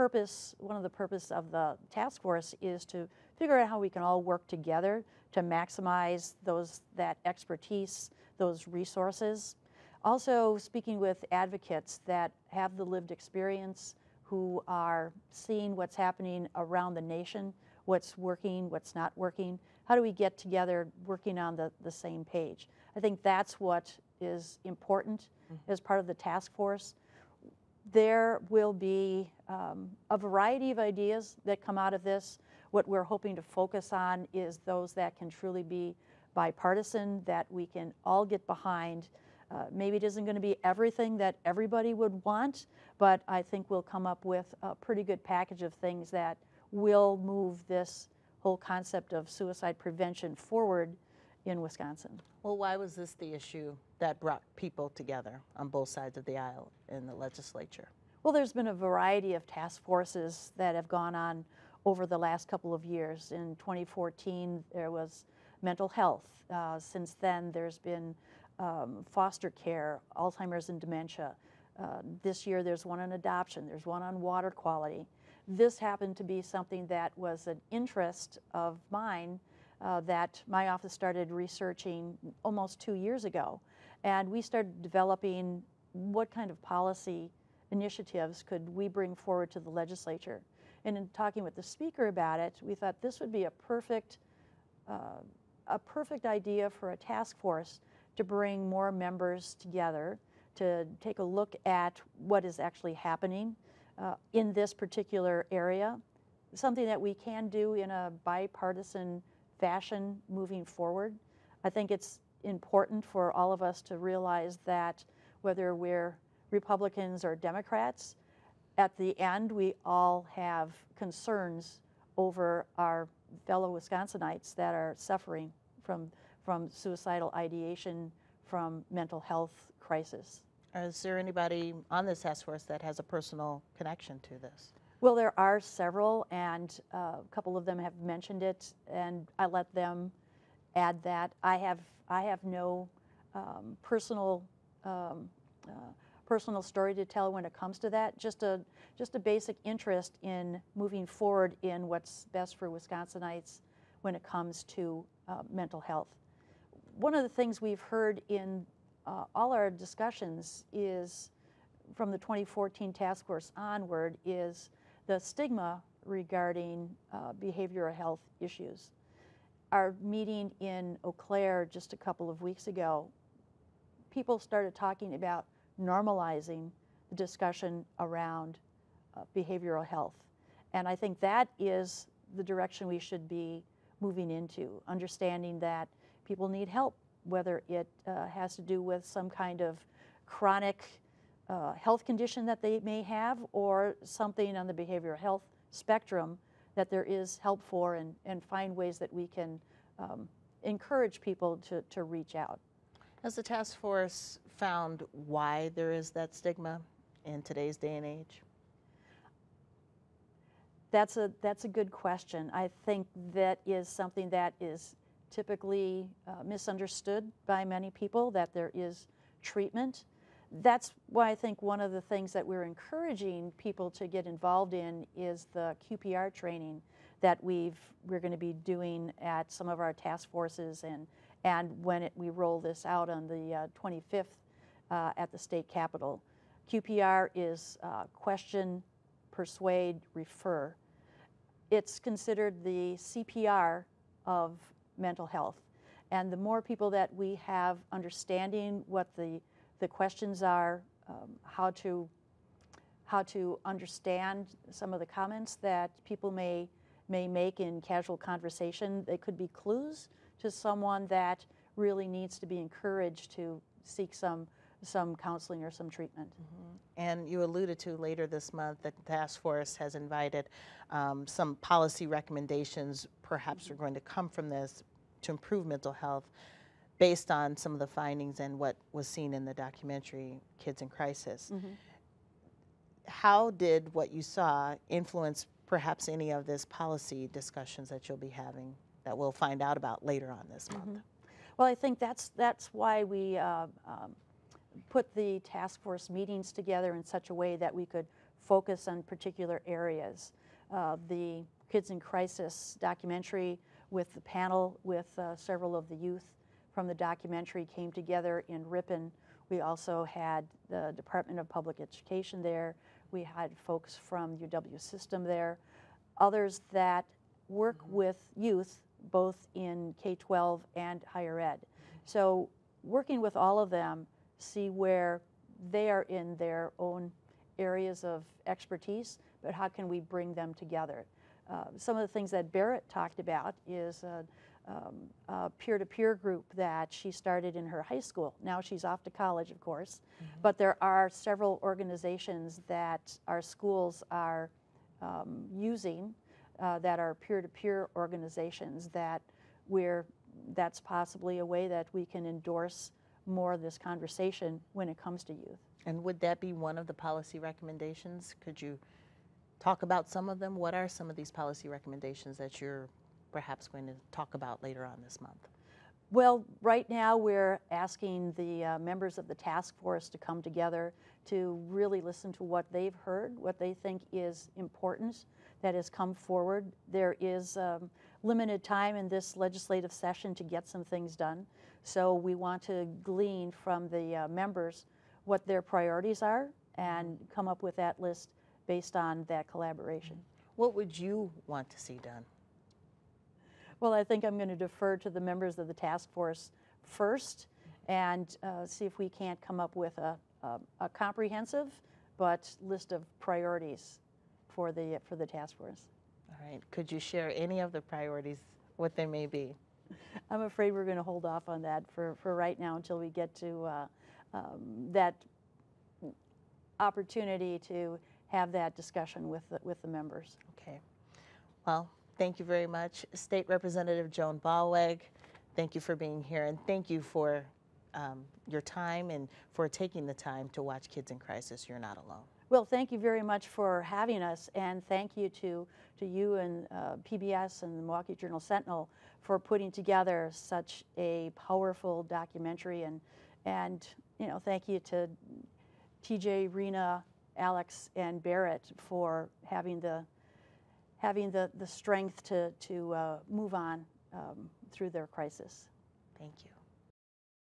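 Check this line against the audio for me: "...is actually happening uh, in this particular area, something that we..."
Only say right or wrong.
right.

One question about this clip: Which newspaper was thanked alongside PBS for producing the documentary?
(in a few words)
Milwaukee Journal Sentinel.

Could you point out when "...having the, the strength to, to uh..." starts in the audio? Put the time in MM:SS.
07:30.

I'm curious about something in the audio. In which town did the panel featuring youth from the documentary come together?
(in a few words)
Ripon.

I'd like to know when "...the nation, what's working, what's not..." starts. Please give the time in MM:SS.
00:16.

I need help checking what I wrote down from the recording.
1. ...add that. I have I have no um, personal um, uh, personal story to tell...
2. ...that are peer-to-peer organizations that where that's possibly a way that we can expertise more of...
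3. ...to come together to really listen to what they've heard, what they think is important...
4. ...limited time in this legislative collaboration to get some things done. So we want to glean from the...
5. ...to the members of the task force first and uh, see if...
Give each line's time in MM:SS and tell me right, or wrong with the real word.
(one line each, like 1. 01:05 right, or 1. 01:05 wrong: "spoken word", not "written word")
1. 02:20 right
2. 05:46 wrong: "endorse", not "expertise"
3. 06:10 right
4. 06:18 wrong: "session", not "collaboration"
5. 06:34 right.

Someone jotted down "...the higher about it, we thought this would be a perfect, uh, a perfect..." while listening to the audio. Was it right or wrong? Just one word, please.
wrong.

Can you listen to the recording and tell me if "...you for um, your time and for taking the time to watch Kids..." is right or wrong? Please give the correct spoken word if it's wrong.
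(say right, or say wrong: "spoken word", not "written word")
right.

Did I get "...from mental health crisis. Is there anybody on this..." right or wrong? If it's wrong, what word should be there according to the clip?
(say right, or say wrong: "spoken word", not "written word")
right.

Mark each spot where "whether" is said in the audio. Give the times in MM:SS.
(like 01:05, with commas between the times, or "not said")
01:55, 03:07.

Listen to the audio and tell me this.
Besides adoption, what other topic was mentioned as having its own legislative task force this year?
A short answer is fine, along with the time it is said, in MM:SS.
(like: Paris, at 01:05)
Water quality, at 01:14.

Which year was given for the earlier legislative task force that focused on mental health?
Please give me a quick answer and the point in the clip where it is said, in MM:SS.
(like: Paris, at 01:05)
2014, at 01:03.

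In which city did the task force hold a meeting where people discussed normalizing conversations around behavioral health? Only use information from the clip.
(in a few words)
Eau Claire.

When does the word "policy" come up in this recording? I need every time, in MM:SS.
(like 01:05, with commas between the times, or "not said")
01:26, 04:31, 04:46, 05:56, 06:01.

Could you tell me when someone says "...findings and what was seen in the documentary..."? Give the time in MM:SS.
04:38.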